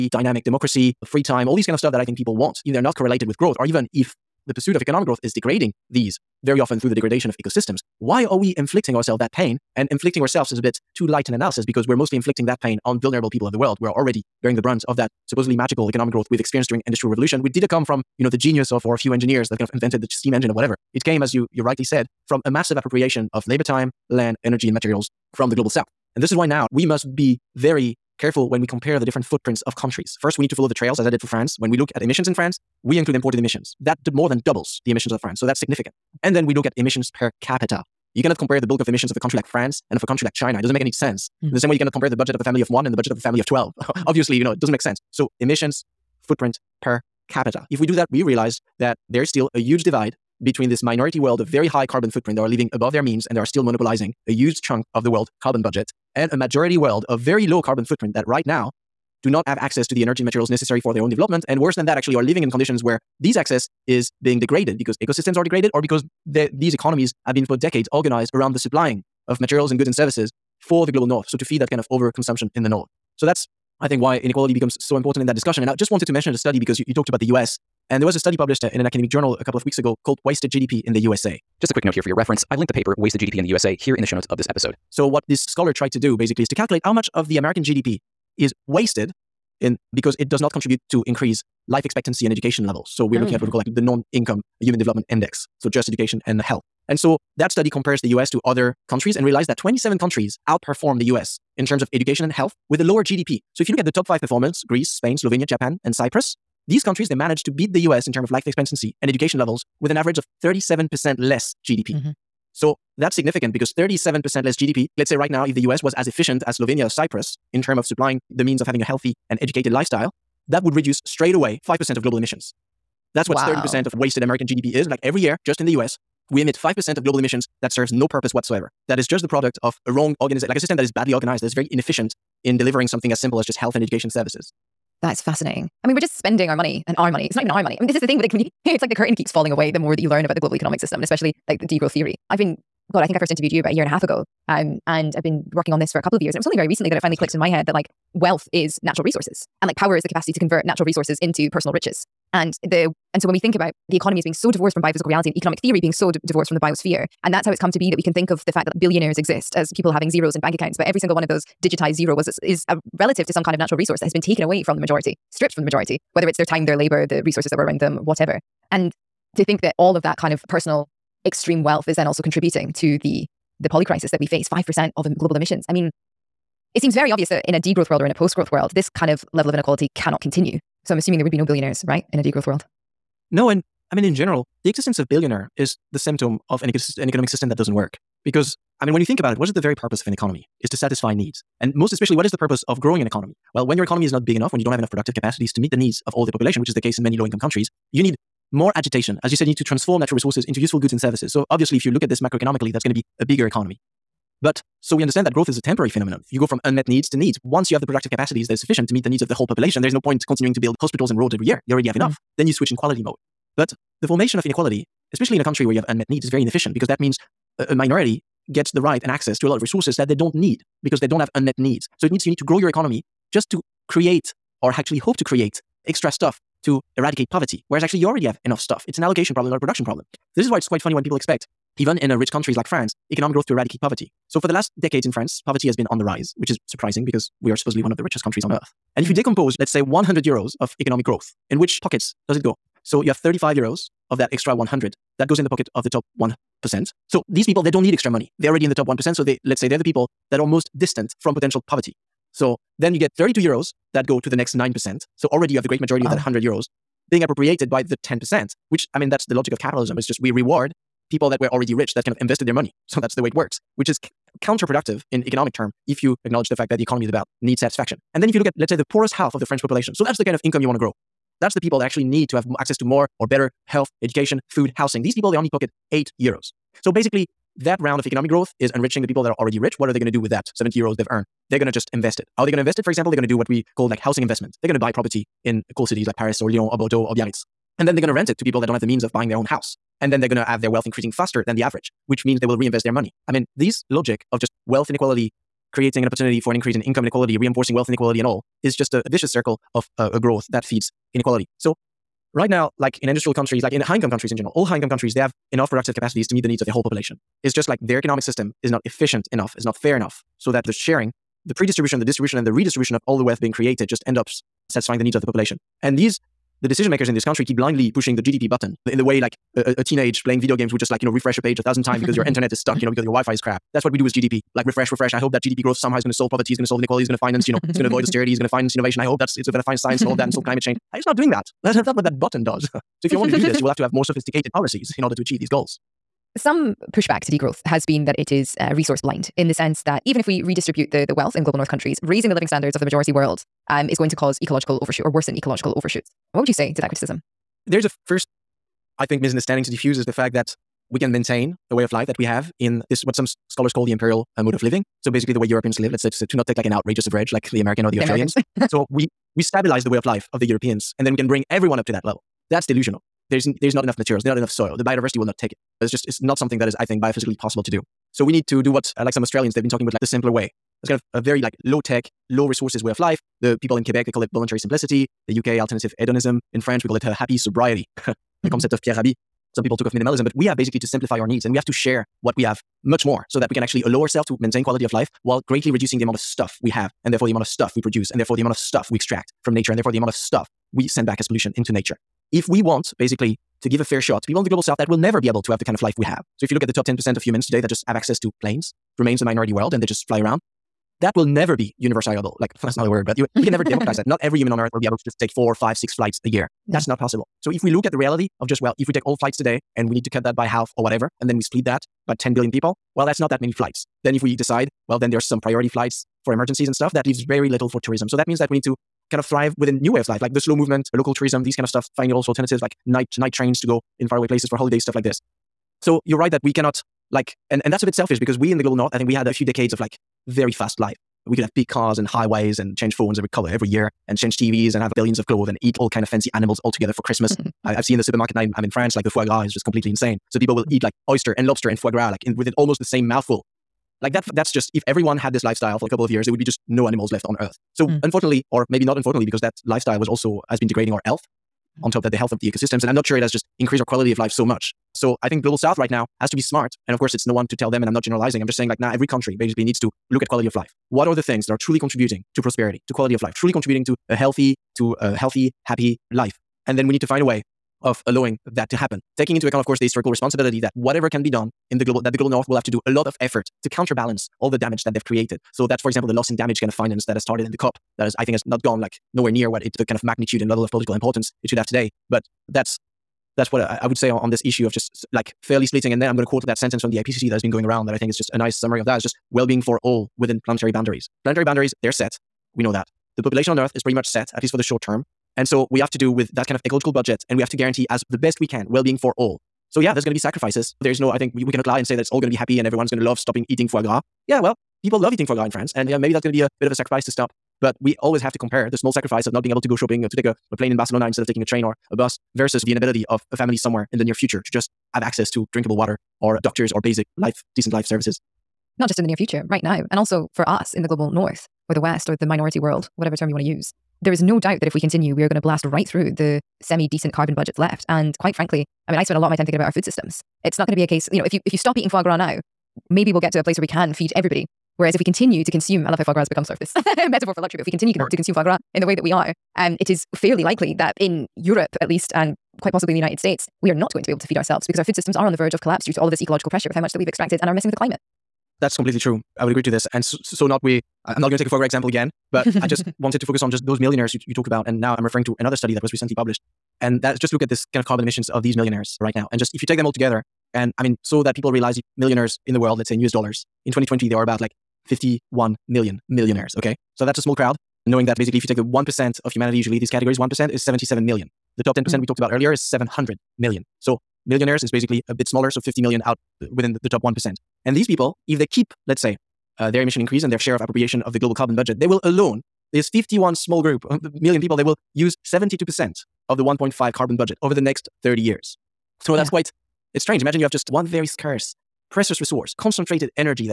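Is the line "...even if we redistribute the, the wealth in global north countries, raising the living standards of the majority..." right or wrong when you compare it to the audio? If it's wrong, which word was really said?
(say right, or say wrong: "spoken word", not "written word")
right.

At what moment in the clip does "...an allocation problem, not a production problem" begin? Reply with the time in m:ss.
3:48.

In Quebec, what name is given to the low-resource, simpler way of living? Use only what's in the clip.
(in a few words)
Voluntary simplicity.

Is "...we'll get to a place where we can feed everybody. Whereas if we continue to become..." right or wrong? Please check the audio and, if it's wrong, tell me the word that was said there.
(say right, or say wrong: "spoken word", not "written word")
wrong: "consume", not "become".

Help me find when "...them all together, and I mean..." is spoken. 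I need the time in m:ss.
9:19.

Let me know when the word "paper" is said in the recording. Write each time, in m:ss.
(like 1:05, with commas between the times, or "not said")
1:22.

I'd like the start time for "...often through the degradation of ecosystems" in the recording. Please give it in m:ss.
0:06.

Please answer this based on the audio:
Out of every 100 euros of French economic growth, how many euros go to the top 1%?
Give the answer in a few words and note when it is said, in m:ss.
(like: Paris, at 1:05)
35 euros, at 4:03.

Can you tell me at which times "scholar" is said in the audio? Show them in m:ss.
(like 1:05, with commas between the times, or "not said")
1:25, 5:53.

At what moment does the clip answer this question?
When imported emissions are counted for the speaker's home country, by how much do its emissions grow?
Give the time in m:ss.
0:34.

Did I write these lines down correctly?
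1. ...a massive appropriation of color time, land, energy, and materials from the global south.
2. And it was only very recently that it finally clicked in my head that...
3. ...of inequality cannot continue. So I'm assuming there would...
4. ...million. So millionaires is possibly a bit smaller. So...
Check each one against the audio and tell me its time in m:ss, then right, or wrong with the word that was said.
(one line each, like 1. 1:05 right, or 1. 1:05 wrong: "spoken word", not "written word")
1. 0:22 wrong: "labor", not "color"
2. 2:26 right
3. 2:59 right
4. 9:33 wrong: "basically", not "possibly".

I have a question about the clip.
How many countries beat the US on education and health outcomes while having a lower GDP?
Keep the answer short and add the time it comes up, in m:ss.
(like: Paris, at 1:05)
27, at 1:39.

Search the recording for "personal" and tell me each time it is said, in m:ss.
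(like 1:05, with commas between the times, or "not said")
2:31, 2:50.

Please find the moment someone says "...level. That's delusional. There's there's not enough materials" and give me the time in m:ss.
6:02.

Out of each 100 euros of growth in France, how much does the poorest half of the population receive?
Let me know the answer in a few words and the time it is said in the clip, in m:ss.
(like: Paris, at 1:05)
8 euros, at 4:35.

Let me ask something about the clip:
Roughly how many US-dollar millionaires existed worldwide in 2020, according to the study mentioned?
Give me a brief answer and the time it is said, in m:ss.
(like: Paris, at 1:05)
51 million, at 9:24.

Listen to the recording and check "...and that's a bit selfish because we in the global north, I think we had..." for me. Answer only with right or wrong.
right.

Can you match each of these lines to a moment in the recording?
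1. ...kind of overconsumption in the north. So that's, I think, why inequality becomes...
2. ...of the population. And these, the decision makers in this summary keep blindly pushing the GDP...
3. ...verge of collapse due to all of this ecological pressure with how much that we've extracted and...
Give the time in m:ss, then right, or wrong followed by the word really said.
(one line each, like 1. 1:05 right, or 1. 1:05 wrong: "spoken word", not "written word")
1. 1:11 right
2. 5:15 wrong: "country", not "summary"
3. 9:05 right.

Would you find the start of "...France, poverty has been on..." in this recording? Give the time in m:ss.
3:55.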